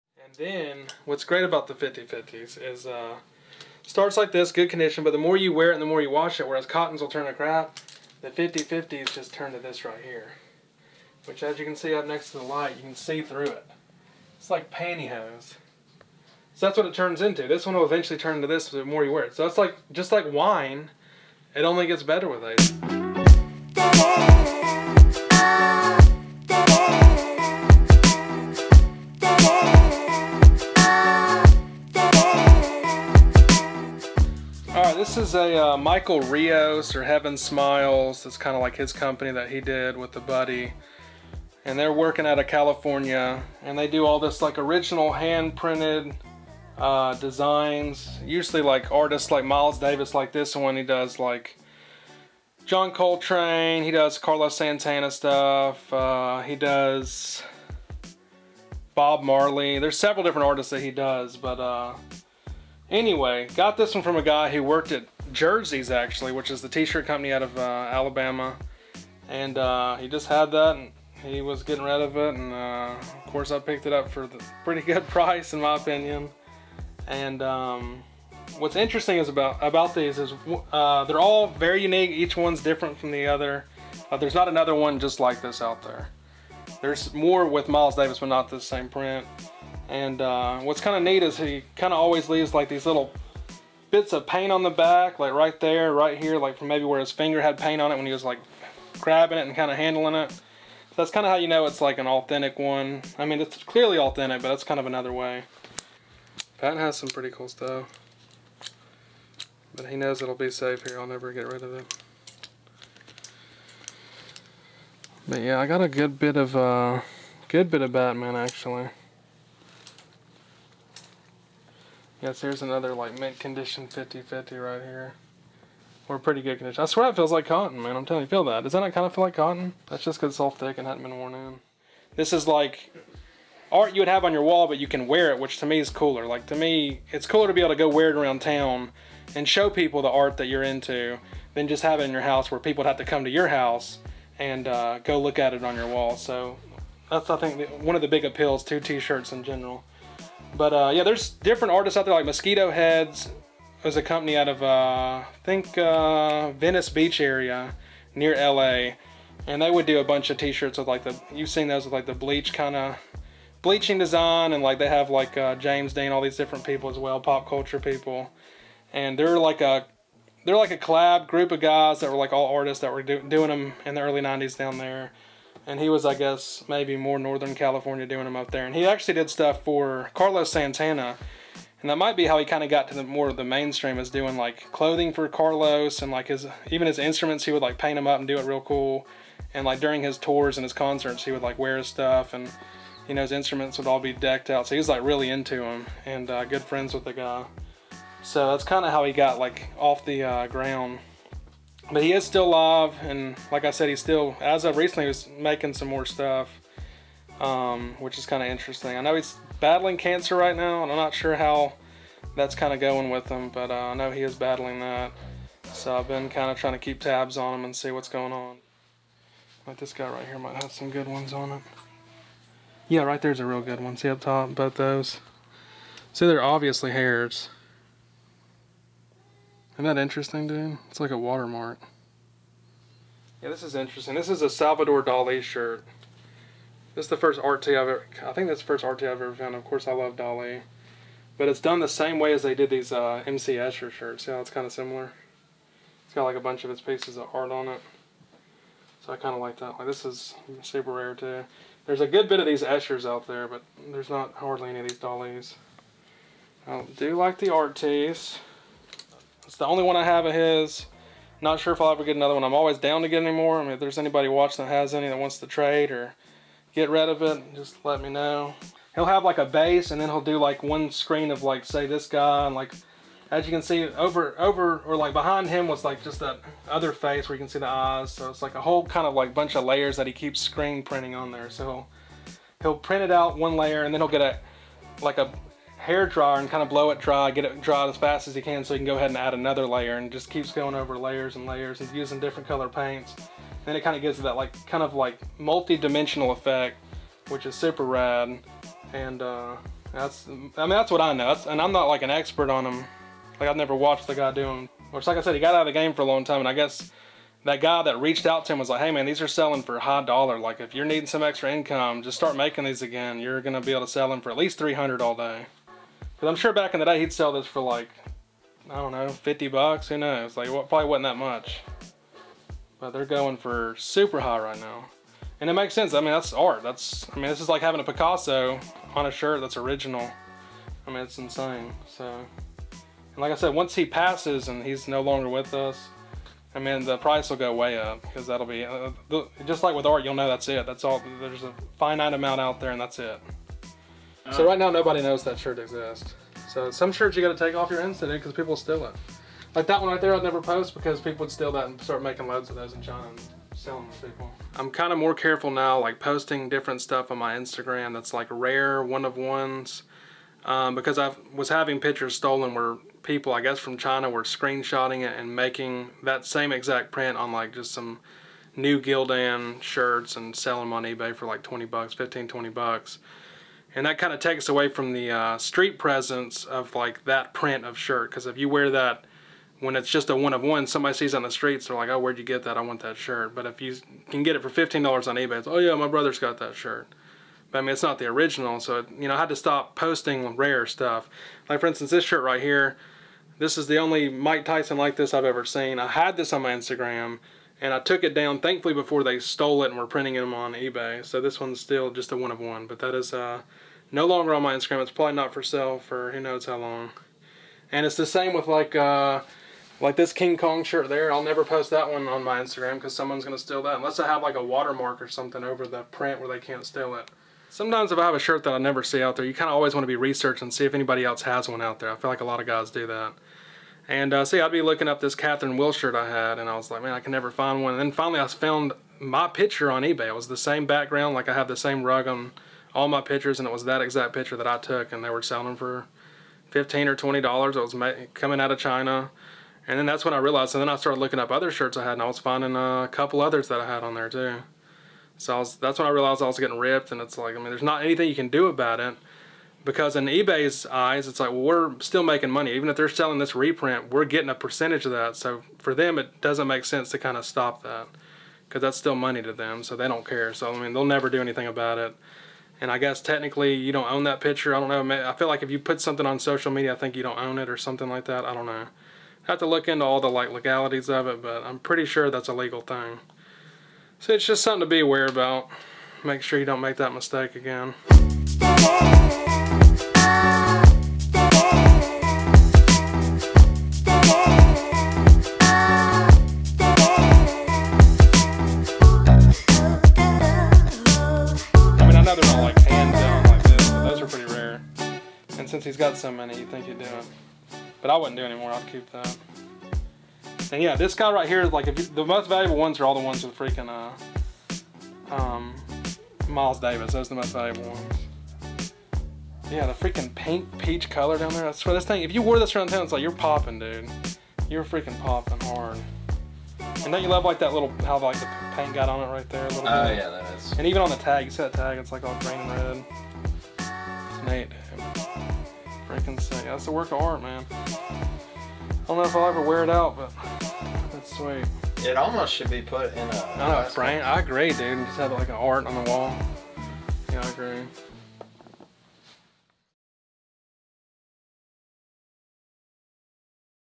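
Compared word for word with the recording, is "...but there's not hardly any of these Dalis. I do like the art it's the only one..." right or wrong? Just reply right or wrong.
right.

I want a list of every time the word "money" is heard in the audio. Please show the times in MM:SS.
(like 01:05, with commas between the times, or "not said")
07:32, 07:38.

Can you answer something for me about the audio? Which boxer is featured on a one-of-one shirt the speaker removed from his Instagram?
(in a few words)
Mike Tyson.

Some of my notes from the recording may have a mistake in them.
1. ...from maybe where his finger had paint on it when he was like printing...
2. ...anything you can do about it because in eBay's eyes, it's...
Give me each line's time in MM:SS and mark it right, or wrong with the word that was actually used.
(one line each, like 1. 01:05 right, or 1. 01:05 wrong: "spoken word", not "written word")
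1. 01:36 wrong: "grabbing", not "printing"
2. 07:27 right.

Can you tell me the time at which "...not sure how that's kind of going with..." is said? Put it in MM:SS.
03:30.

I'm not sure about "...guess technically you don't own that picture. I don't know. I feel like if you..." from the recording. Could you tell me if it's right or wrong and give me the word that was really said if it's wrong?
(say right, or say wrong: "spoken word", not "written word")
right.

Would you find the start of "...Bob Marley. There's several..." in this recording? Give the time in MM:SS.
00:58.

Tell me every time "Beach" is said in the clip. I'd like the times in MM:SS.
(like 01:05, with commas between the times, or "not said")
02:36.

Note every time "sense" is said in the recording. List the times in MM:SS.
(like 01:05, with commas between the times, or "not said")
05:25, 07:36.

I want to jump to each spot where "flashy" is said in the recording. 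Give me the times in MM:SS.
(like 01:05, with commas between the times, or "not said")
not said.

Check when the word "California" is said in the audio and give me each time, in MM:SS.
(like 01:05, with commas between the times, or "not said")
00:42, 02:57.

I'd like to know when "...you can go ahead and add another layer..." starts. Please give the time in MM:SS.
04:48.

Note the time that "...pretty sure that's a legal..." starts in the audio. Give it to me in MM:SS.
07:51.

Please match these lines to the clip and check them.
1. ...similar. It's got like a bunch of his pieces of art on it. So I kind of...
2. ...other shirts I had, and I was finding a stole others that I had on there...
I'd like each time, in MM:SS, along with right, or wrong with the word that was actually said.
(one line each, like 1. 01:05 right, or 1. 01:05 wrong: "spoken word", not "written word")
1. 04:04 right
2. 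07:21 wrong: "couple", not "stole".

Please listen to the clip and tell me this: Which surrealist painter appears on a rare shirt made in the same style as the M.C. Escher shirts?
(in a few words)
Salvador Dali.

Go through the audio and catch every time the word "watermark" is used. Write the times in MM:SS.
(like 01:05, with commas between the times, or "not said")
03:51, 06:54.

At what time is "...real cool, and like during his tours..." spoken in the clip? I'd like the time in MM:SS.
03:08.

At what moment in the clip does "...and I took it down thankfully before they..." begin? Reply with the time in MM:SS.
06:37.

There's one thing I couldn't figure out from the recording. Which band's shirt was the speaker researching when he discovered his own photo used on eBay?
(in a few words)
Catherine Wheel.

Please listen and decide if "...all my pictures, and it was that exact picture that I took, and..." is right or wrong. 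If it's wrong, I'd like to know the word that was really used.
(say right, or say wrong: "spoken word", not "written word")
right.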